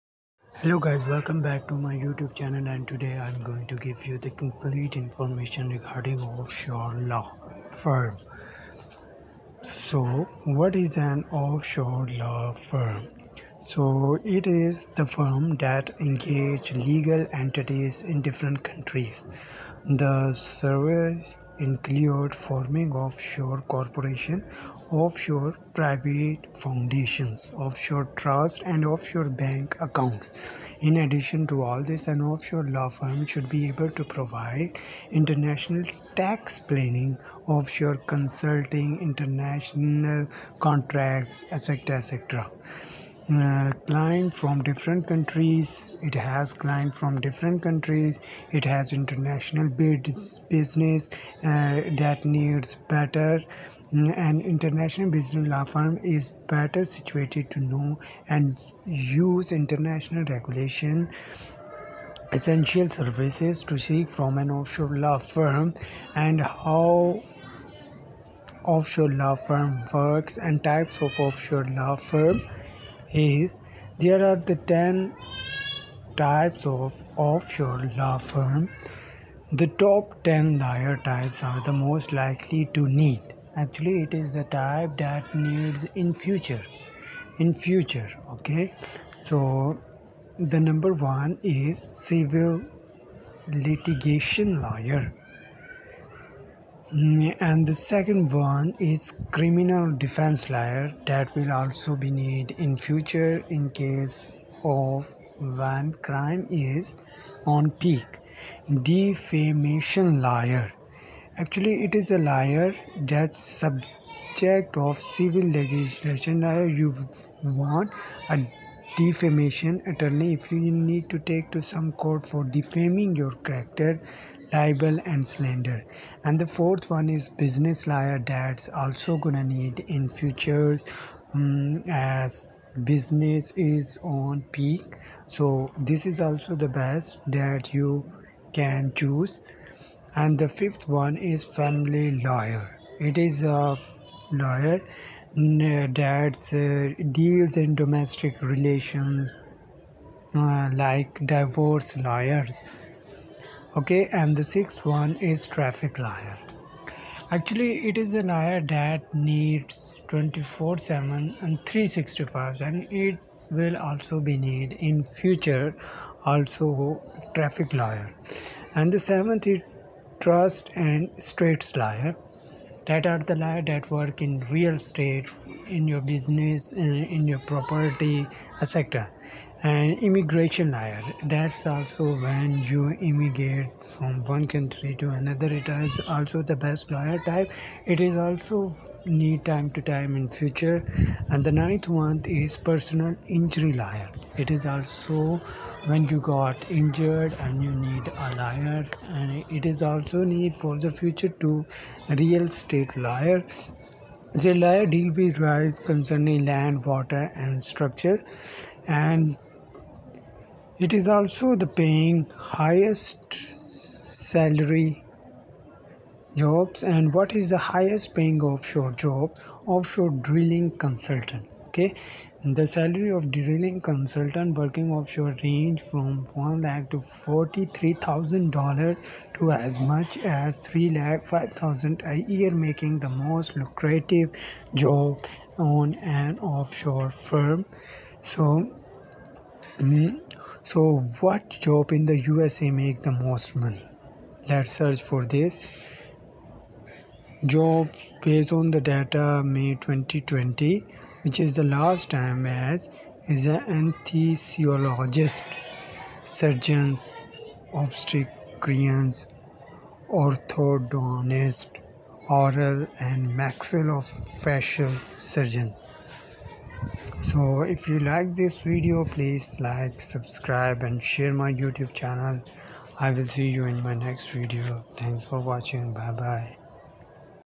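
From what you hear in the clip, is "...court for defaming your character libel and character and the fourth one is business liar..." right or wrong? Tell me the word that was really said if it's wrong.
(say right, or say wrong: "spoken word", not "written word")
wrong: "slander", not "character".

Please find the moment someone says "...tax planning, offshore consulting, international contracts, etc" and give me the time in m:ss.
0:36.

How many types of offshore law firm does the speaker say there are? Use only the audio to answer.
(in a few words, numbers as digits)
10.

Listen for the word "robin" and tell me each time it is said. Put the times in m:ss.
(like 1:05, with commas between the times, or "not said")
not said.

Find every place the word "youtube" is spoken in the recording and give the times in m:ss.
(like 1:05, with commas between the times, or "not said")
0:01, 4:31.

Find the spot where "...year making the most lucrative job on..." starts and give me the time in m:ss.
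3:52.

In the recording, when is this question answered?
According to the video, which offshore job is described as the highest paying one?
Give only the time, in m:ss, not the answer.
3:39.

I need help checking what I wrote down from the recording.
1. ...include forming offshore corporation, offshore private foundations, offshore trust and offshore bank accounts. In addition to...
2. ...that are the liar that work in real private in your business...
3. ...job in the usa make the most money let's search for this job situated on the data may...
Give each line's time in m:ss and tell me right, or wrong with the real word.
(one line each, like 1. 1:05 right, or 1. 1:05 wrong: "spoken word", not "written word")
1. 0:21 right
2. 2:52 wrong: "estate", not "private"
3. 4:01 wrong: "based", not "situated".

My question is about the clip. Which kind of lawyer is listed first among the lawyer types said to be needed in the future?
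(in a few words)
Civil litigation lawyer.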